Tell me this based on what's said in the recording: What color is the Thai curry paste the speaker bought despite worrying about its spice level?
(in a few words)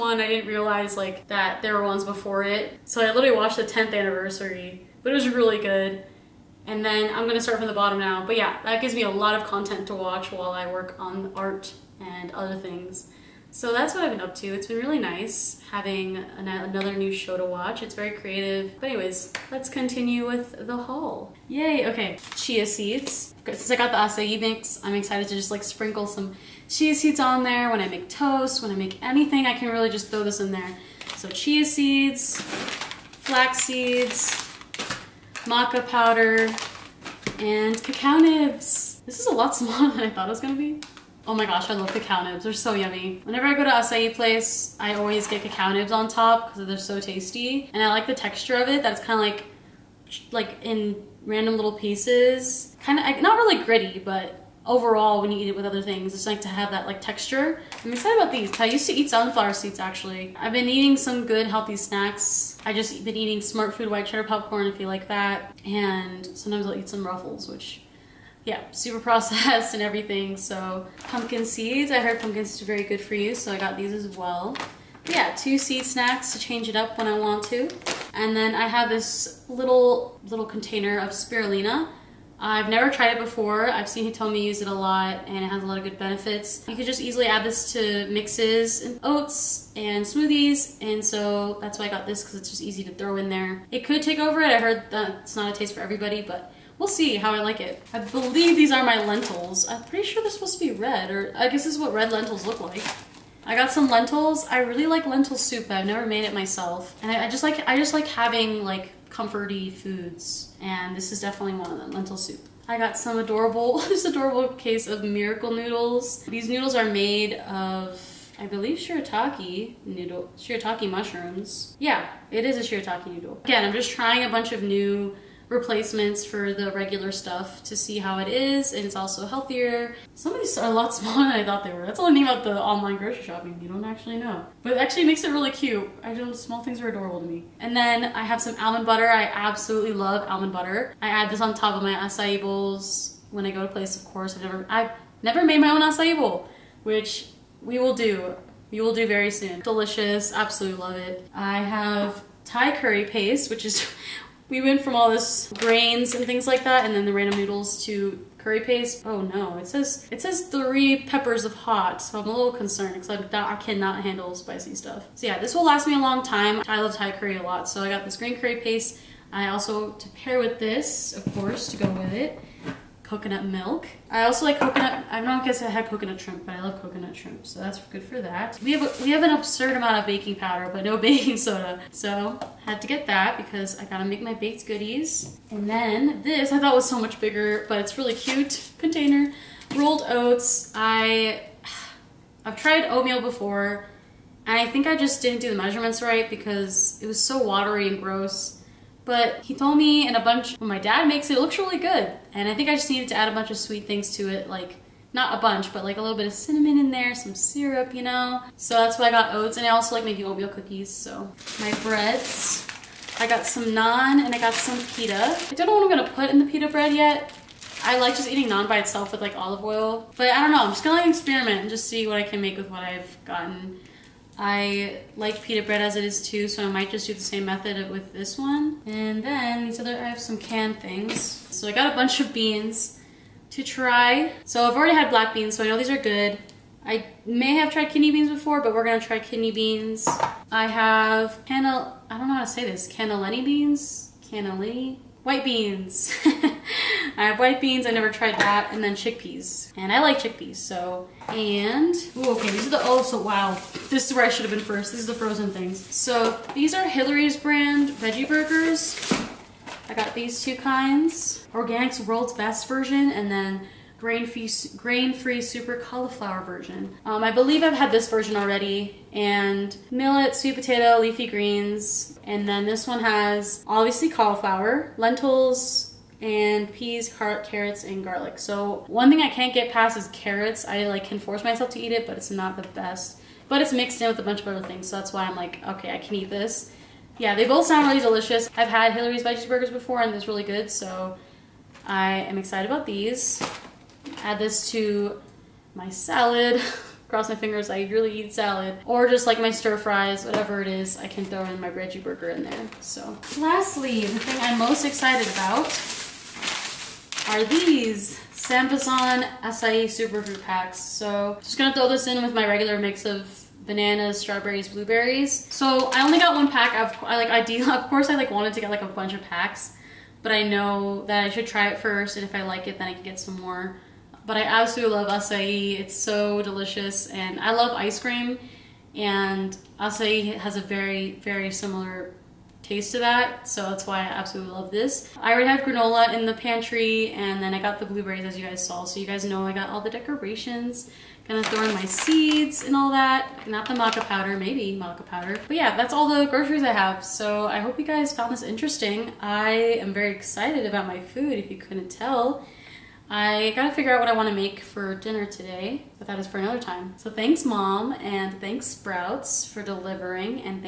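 green.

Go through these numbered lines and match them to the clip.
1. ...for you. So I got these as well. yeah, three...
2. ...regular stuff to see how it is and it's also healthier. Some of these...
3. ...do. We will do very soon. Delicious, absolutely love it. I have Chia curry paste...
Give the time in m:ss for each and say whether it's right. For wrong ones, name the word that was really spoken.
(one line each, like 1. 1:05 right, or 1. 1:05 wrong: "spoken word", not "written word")
1. 1:13 wrong: "two", not "three"
2. 2:06 right
3. 2:27 wrong: "Thai", not "Chia".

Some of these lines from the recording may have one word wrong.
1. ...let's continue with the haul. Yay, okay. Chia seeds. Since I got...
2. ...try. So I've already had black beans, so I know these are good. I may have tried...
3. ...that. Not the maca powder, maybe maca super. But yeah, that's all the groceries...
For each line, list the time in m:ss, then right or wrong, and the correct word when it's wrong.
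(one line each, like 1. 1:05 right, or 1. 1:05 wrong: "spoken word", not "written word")
1. 0:19 right
2. 3:53 right
3. 5:42 wrong: "powder", not "super".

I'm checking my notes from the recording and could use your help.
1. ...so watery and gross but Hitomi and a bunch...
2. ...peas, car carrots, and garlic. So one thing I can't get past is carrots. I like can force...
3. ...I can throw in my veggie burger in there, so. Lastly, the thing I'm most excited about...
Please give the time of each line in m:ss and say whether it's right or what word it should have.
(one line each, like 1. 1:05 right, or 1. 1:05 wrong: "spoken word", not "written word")
1. 3:17 right
2. 4:36 right
3. 5:00 right.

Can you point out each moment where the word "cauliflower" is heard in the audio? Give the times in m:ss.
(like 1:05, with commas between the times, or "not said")
4:25, 4:34.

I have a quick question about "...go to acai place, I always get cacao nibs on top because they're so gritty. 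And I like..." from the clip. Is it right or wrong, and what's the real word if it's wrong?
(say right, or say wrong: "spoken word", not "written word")
wrong: "tasty", not "gritty".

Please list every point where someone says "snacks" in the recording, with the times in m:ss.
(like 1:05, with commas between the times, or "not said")
1:01, 1:15.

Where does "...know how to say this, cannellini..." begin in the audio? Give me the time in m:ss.
4:02.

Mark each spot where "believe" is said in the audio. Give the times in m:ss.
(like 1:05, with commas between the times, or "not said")
1:37, 1:58, 4:27.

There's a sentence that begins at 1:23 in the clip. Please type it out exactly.
I've seen Hitomi use it a lot and it has a lot of good benefits.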